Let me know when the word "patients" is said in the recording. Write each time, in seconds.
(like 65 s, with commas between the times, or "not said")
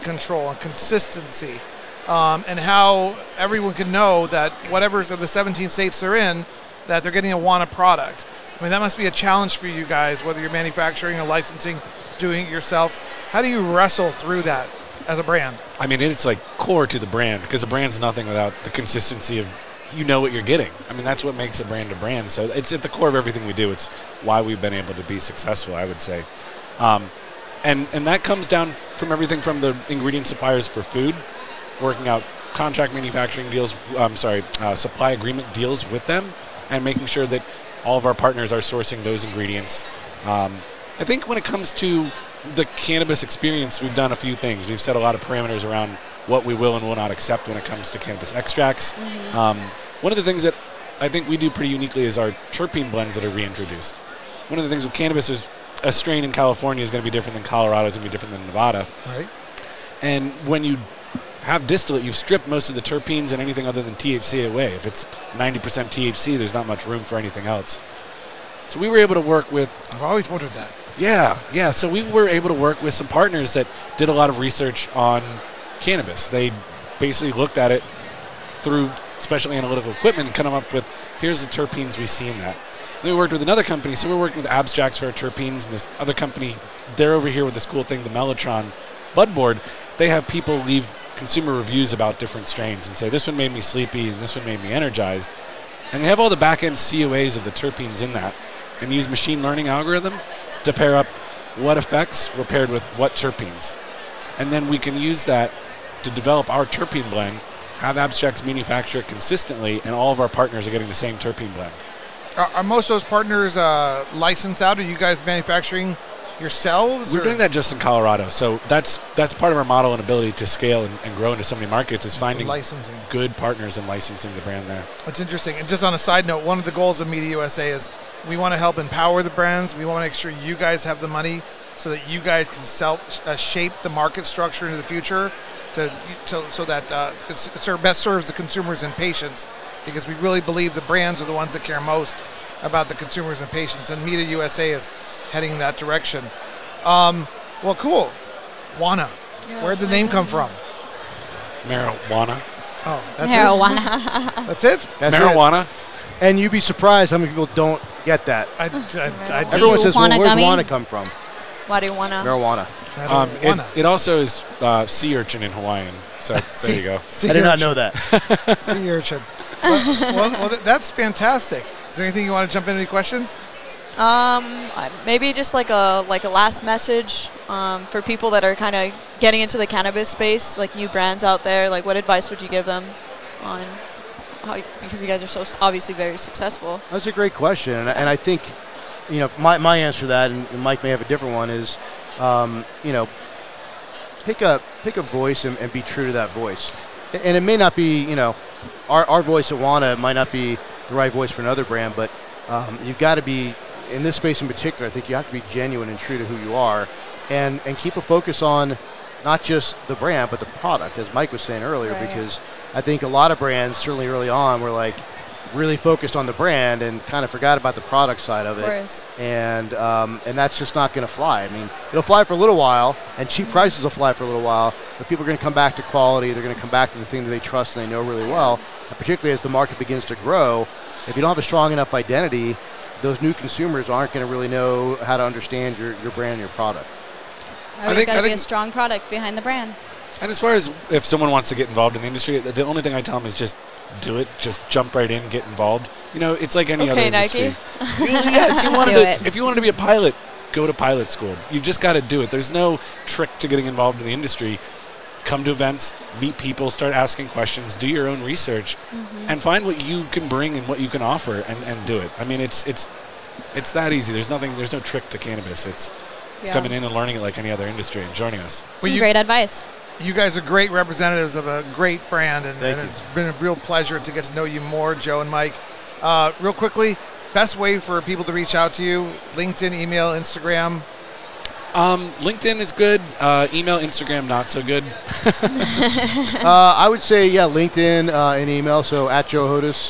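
138 s, 143 s.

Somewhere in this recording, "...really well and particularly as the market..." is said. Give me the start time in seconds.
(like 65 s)
228 s.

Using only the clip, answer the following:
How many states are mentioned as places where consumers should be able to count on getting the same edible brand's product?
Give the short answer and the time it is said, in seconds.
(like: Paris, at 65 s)
17, at 5 s.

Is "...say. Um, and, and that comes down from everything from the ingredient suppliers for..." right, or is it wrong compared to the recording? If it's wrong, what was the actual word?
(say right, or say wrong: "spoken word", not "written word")
right.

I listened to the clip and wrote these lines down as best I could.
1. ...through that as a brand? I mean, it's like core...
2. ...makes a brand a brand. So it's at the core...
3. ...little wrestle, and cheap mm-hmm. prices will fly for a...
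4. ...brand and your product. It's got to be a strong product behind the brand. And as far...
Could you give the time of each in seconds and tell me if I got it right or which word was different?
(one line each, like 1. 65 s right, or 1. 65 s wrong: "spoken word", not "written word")
1. 14 s right
2. 21 s right
3. 222 s wrong: "while", not "wrestle"
4. 236 s right.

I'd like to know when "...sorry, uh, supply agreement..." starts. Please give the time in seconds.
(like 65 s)
34 s.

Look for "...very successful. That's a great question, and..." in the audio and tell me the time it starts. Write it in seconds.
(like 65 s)
185 s.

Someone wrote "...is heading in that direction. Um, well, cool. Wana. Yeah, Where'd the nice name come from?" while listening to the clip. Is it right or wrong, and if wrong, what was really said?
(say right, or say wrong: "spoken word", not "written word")
right.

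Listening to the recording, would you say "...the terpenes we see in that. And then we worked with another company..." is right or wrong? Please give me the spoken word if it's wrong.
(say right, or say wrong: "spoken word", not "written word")
right.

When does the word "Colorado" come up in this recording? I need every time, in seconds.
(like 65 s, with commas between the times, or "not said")
57 s, 117 s.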